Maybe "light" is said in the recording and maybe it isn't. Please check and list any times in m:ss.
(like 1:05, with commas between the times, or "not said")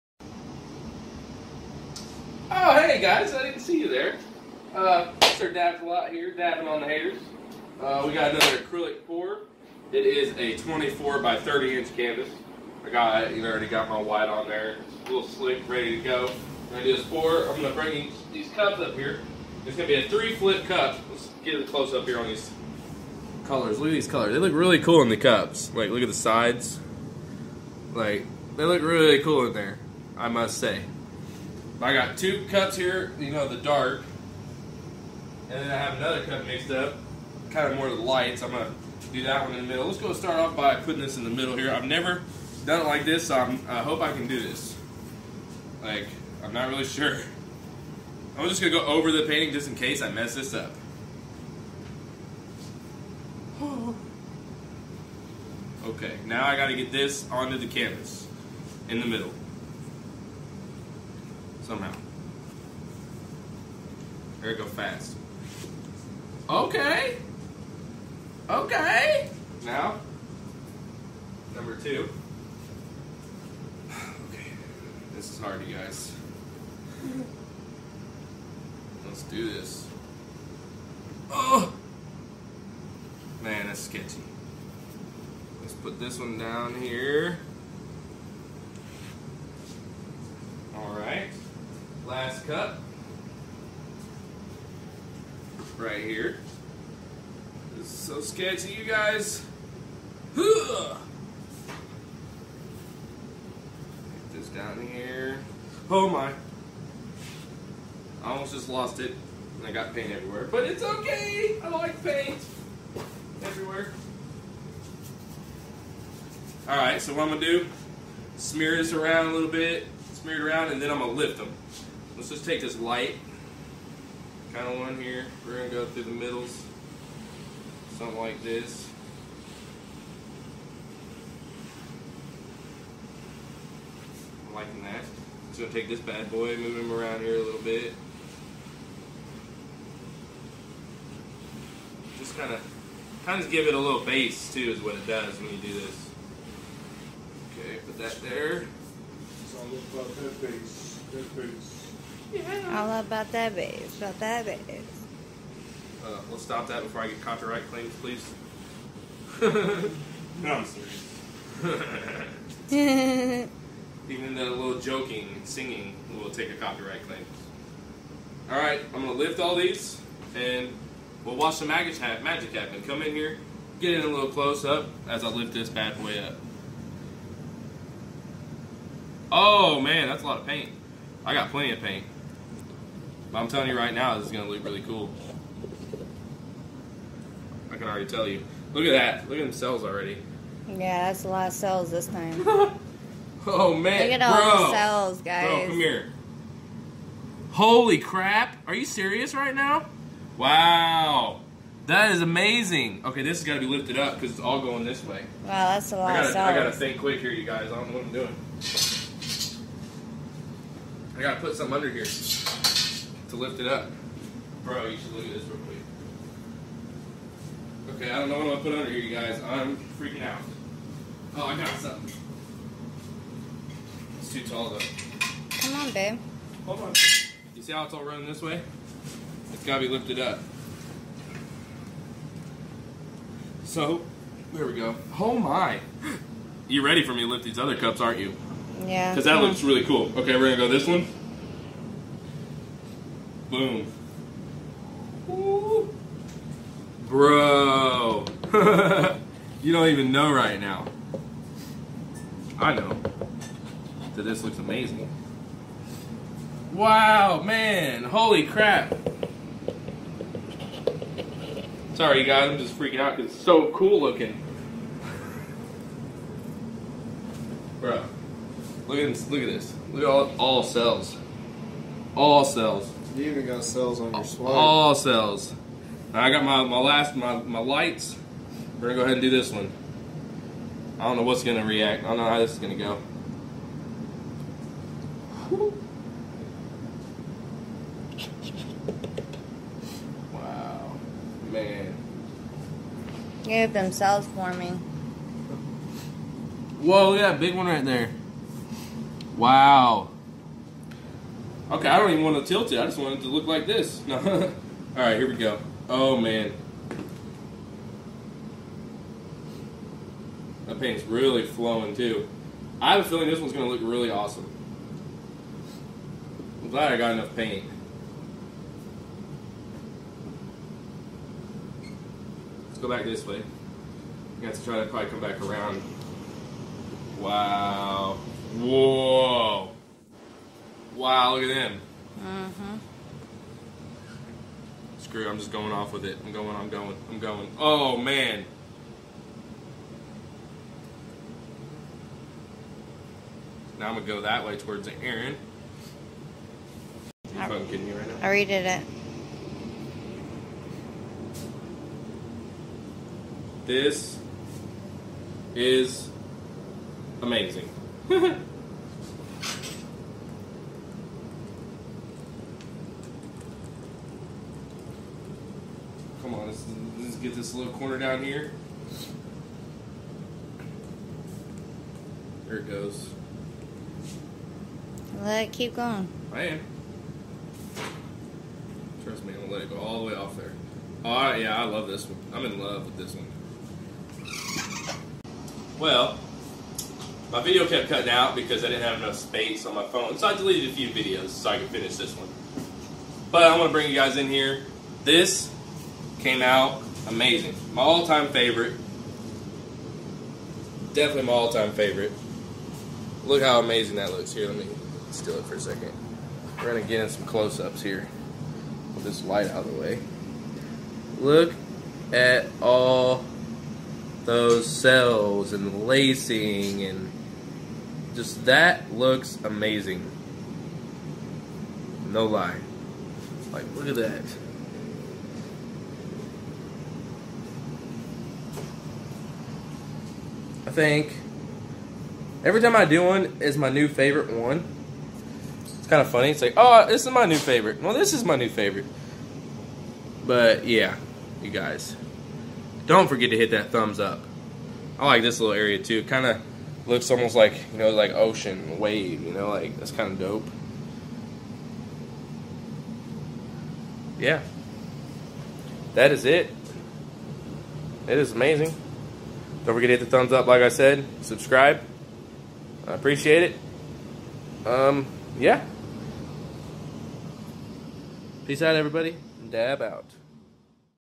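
0:38, 2:02, 4:37, 6:49.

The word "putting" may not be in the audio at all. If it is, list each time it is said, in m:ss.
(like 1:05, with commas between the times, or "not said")
0:40.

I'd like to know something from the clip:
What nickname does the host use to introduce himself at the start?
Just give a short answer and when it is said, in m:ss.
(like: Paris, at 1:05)
Mr. Dabs a lot, at 0:05.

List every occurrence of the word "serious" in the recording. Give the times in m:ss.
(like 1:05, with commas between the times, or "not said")
2:40, 3:18.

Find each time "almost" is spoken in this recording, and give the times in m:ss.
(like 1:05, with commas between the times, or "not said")
1:48, 7:27.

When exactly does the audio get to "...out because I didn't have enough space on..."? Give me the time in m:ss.
6:28.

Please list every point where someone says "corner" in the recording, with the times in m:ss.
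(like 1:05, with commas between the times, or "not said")
6:07.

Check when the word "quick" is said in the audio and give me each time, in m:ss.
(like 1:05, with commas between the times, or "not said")
3:26, 3:35.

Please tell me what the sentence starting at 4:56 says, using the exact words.
Whoa, look at that big one right there.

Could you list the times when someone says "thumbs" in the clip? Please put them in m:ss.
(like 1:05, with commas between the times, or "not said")
7:23, 7:40.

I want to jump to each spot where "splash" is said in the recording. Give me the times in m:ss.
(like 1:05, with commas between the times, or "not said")
not said.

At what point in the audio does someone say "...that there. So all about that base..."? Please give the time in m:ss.
2:27.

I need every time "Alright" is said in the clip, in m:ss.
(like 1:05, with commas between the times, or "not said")
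1:56, 2:48.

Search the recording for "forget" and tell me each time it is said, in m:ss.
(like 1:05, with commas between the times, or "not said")
7:23, 7:39.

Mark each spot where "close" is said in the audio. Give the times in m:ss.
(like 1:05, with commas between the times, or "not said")
0:21, 2:54, 6:47.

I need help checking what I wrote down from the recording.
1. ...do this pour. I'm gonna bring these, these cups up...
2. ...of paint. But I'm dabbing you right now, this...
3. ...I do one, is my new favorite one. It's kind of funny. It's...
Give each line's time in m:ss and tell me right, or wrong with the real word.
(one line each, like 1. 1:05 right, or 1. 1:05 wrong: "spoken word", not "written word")
1. 0:16 right
2. 3:01 wrong: "telling", not "dabbing"
3. 7:12 right.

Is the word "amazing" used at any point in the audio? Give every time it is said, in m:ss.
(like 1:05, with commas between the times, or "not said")
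3:22, 4:14, 5:57, 6:37, 6:43, 6:59, 7:38.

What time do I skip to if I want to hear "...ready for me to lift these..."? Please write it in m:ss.
3:56.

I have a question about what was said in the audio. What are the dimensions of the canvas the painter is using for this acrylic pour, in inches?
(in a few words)
24 by 30 inches.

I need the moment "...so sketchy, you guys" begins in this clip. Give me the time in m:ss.
1:37.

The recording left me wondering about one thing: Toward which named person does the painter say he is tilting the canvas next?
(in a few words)
Aaron.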